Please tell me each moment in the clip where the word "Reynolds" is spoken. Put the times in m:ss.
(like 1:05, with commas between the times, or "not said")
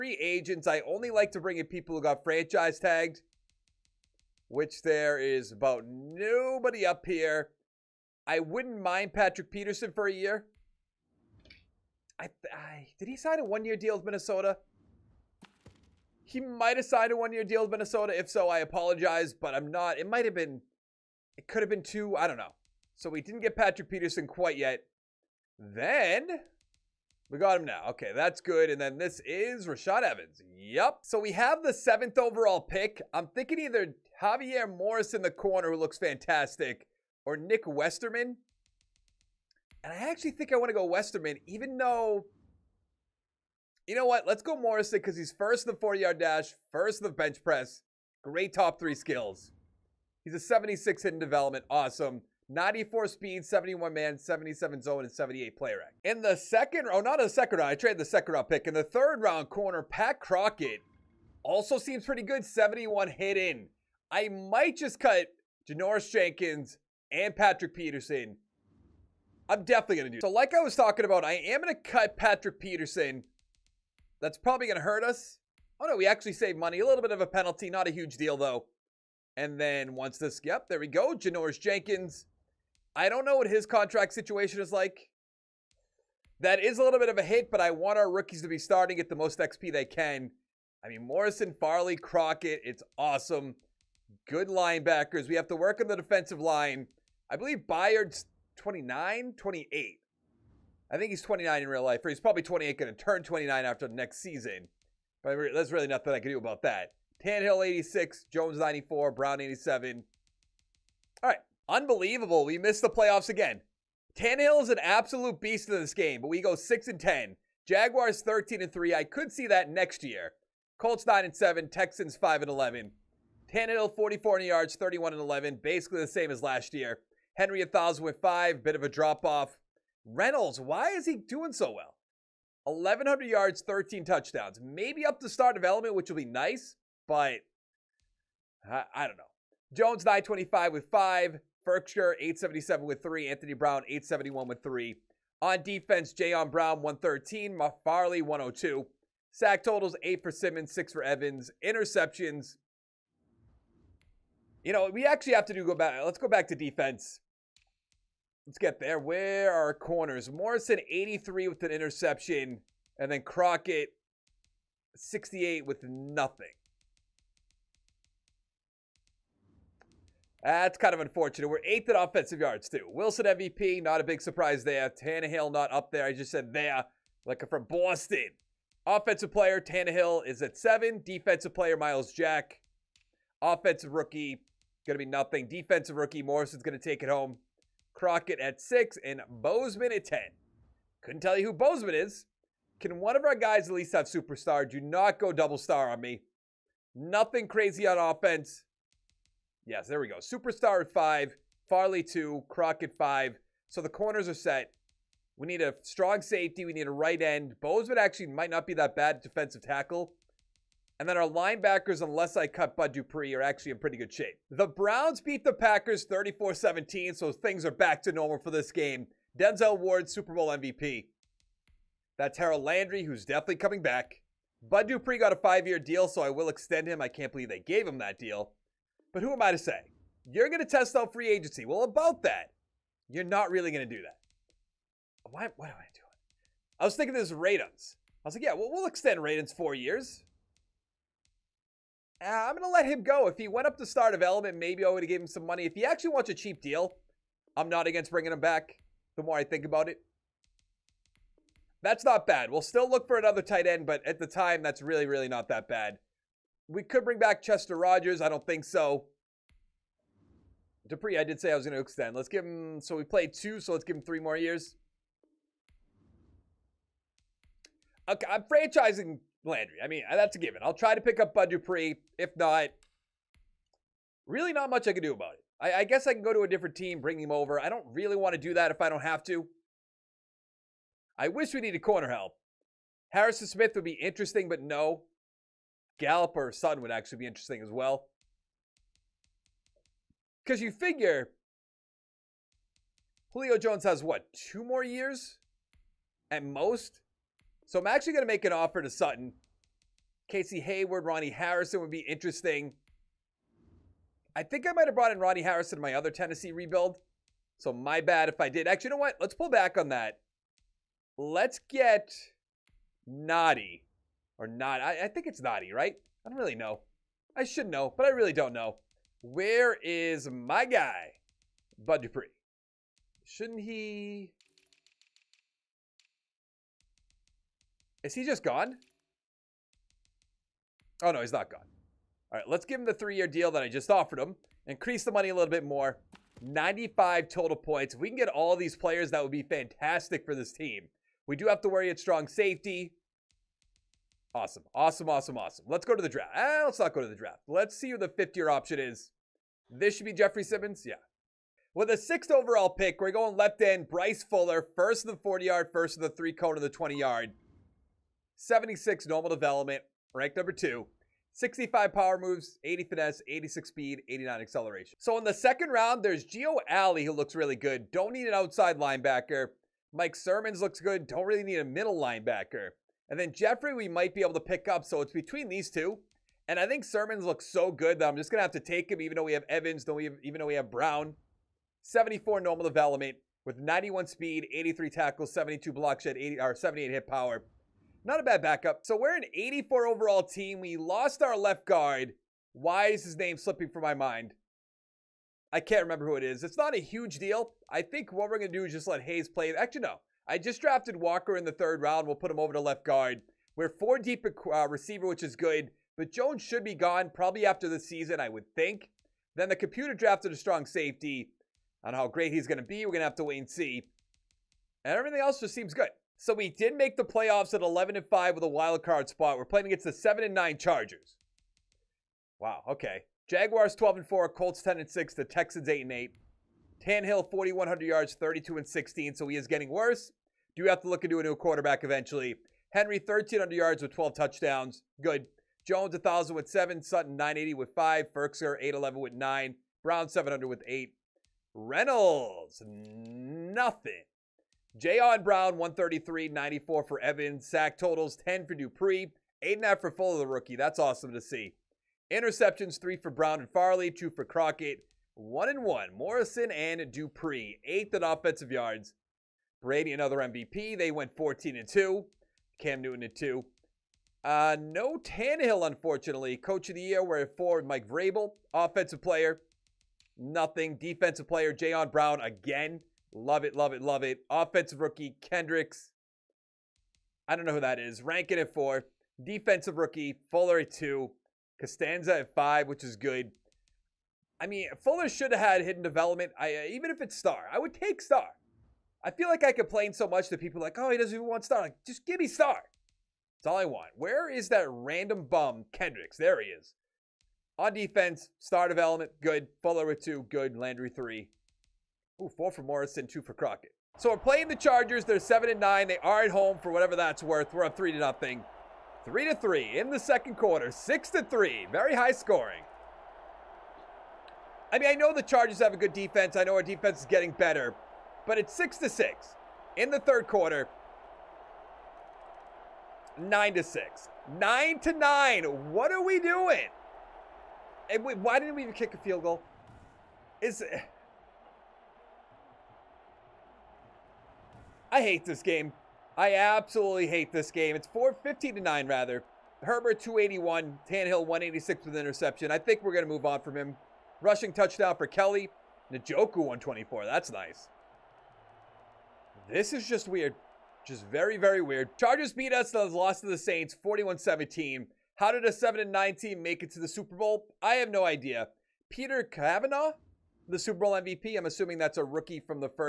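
2:10, 7:21.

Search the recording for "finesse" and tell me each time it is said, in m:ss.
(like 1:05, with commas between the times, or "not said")
6:02.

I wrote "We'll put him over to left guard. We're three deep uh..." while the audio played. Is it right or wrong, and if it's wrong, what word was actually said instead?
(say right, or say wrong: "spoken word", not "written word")
wrong: "four", not "three".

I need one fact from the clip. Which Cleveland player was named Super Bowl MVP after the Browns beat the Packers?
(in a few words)
Denzel Ward.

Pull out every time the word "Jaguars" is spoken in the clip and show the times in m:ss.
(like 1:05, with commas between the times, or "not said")
1:57, 7:03.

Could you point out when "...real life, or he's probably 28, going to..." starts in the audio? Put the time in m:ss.
1:41.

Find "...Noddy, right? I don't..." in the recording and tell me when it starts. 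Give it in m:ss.
5:15.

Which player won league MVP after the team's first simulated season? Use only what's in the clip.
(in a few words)
Wilson.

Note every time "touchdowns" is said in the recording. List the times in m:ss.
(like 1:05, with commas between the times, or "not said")
2:14, 7:14, 9:04.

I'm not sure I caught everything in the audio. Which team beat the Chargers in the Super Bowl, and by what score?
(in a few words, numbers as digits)
Saints, 41-17.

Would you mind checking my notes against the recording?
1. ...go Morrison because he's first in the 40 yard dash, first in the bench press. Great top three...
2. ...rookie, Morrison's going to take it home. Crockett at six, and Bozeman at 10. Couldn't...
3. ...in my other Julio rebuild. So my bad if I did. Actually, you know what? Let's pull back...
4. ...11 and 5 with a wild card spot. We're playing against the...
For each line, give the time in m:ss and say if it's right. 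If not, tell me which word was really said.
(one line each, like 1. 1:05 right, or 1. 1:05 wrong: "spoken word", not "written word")
1. 0:44 right
2. 3:05 right
3. 5:05 wrong: "Tennessee", not "Julio"
4. 6:57 right.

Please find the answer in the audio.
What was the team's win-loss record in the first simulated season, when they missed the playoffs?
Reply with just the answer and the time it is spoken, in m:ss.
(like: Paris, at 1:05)
6 and 10, at 1:56.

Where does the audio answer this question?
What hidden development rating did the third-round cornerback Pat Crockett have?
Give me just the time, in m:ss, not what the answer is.
1:02.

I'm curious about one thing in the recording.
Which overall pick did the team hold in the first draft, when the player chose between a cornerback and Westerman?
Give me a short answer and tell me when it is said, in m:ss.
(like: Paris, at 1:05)
7th, at 0:31.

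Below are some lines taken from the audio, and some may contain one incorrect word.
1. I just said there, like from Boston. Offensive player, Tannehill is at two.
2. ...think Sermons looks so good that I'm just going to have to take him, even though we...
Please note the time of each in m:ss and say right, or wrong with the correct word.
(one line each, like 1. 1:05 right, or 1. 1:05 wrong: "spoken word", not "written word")
1. 2:56 wrong: "seven", not "two"
2. 6:16 right.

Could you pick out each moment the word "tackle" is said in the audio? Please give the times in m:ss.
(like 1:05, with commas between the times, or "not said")
3:29, 6:24.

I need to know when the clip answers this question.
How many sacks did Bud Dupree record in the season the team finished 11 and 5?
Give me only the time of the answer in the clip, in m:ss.
7:28.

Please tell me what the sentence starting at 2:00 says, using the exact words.
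Colts 9 and 7, Texans 5 and 11.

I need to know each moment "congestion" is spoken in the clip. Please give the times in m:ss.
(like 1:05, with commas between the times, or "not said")
not said.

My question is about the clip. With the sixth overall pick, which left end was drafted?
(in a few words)
Bryce Fuller.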